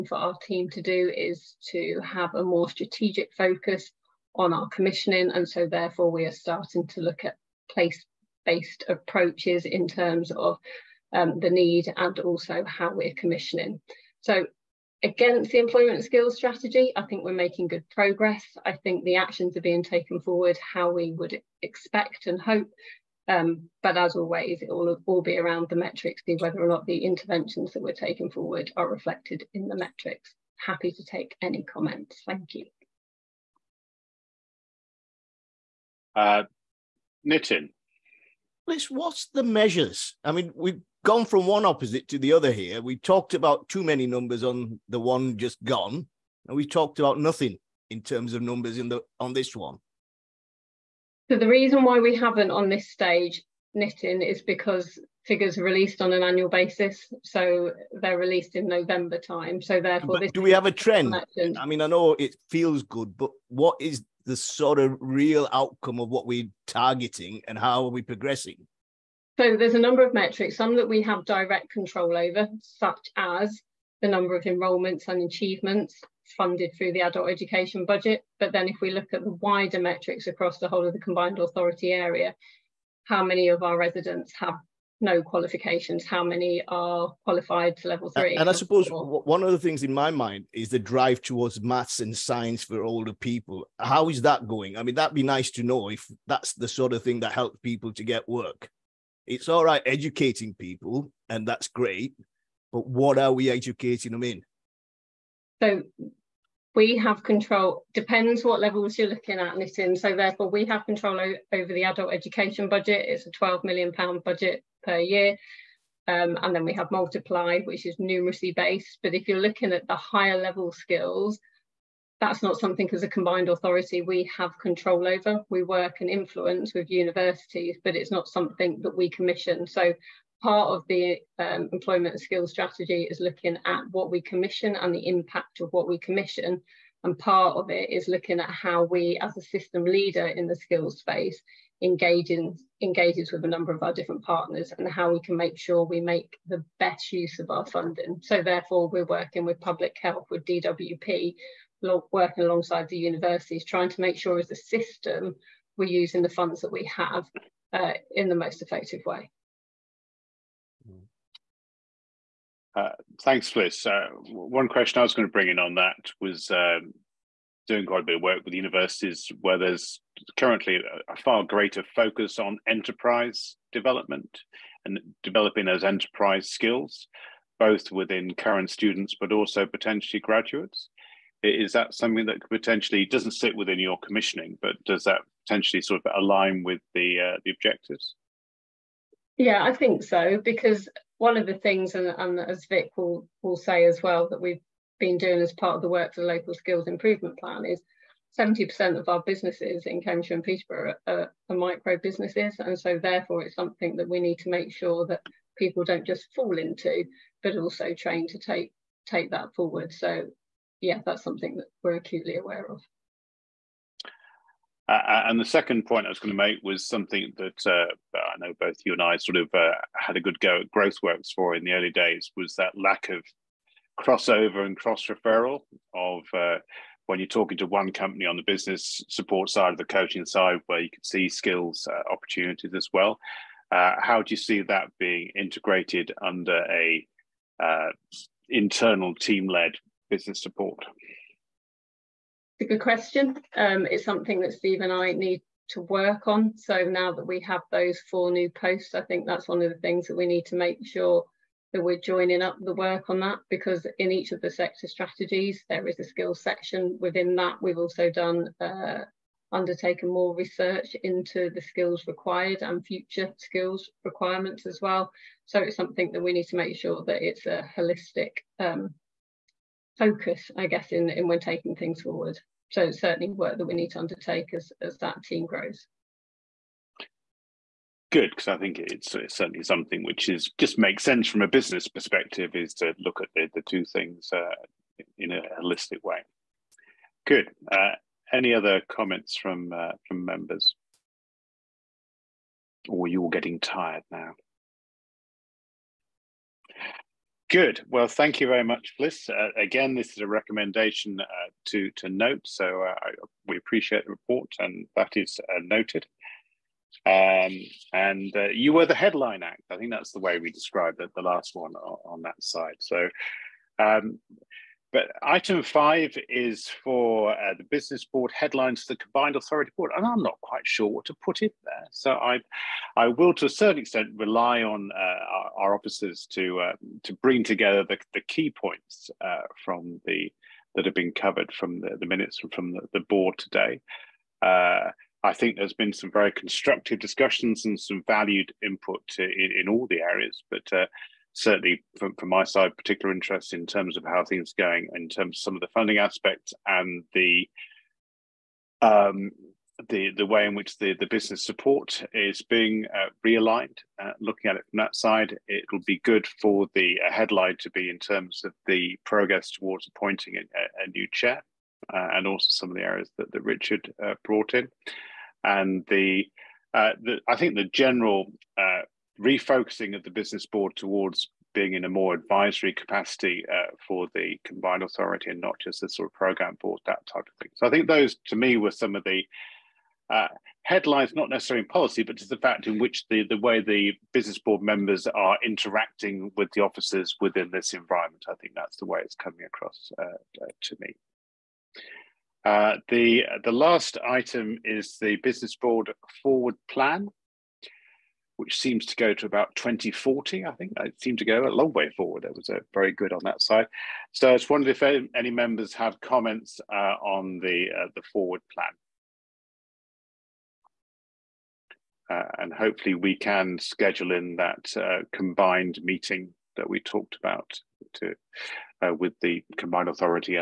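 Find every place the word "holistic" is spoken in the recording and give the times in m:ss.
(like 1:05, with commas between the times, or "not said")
4:27, 4:45.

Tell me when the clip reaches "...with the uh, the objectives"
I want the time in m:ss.
3:06.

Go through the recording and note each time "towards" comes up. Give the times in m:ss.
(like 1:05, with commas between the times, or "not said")
1:31, 5:59, 6:10.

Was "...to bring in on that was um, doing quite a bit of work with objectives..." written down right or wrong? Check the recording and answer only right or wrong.
wrong.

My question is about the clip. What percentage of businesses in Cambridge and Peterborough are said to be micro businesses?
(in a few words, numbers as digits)
70%.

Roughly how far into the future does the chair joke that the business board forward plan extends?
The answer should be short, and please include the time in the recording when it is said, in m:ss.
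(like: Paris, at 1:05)
2040, at 6:39.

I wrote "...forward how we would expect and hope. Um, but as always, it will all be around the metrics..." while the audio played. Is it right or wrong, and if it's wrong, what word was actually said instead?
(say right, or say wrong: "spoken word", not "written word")
right.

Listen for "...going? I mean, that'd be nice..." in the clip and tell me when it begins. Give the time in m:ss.
1:34.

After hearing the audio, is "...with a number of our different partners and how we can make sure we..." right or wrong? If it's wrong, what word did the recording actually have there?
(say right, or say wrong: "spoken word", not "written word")
right.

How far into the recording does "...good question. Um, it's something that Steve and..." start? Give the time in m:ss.
4:02.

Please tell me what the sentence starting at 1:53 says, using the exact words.
It's a £12 million budget per year.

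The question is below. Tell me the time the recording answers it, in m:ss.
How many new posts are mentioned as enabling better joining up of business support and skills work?
4:08.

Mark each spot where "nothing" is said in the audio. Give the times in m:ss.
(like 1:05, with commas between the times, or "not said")
0:47.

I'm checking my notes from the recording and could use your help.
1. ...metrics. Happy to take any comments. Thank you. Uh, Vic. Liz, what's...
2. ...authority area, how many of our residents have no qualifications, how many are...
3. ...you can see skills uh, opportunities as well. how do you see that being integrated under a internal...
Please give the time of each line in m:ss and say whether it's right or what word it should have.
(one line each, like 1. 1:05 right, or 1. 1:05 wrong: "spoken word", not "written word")
1. 0:29 wrong: "Nitin", not "Vic"
2. 1:21 right
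3. 3:50 right.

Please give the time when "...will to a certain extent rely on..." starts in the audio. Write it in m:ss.
5:23.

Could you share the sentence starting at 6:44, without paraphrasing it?
So I just wondered if any, members have comments uh, on the, uh, the forward plan.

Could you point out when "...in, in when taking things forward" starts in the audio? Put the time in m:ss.
4:30.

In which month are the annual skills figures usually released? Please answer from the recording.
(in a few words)
November.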